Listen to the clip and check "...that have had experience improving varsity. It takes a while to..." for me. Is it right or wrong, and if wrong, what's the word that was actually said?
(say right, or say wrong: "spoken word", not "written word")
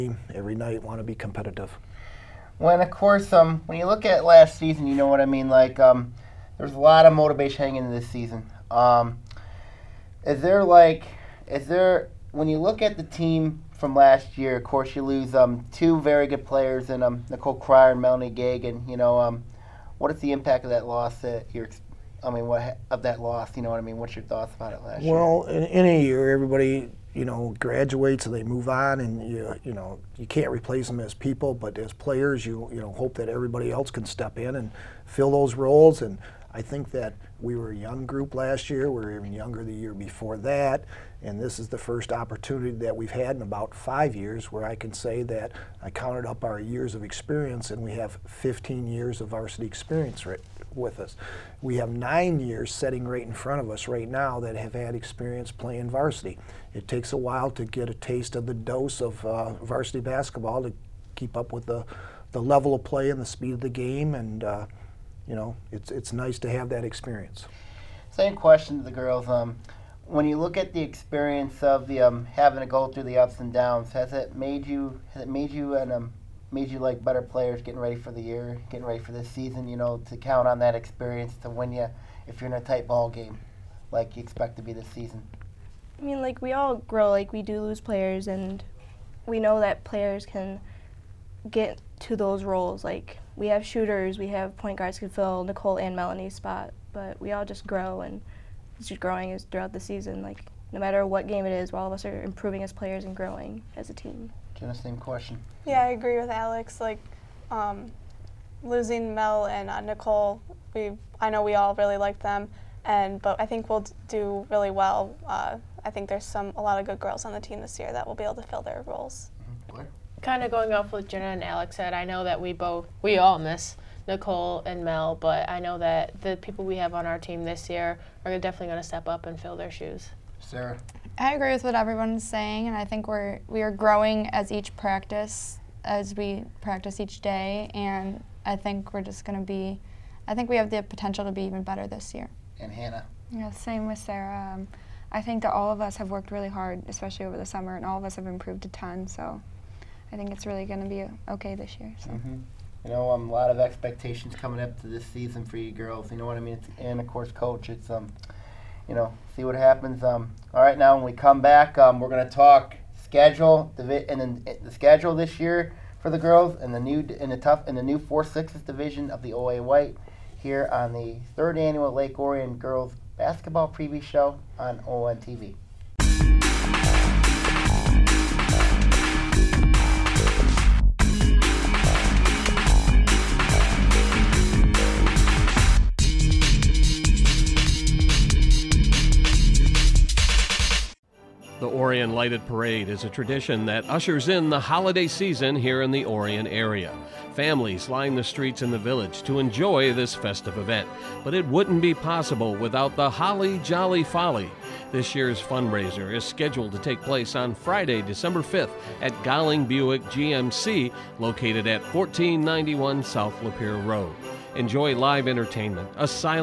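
wrong: "playing", not "improving".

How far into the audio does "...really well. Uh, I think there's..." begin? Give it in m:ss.
1:54.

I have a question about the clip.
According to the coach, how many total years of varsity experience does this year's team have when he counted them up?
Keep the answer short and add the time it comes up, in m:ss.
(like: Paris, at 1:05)
15, at 0:48.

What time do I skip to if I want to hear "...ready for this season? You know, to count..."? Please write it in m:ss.
1:18.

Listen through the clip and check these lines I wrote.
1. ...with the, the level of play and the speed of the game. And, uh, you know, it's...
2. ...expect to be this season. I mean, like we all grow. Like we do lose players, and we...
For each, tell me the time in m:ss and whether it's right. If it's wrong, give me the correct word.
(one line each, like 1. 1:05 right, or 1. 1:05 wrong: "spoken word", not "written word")
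1. 1:01 right
2. 1:24 right.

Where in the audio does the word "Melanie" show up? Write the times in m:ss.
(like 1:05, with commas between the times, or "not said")
0:18, 1:35.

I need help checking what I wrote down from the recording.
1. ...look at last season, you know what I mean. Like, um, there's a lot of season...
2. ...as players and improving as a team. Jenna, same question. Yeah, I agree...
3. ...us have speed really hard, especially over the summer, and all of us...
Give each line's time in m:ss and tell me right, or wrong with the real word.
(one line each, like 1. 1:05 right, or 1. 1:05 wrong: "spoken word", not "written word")
1. 0:03 wrong: "motivation", not "season"
2. 1:42 wrong: "growing", not "improving"
3. 2:25 wrong: "worked", not "speed".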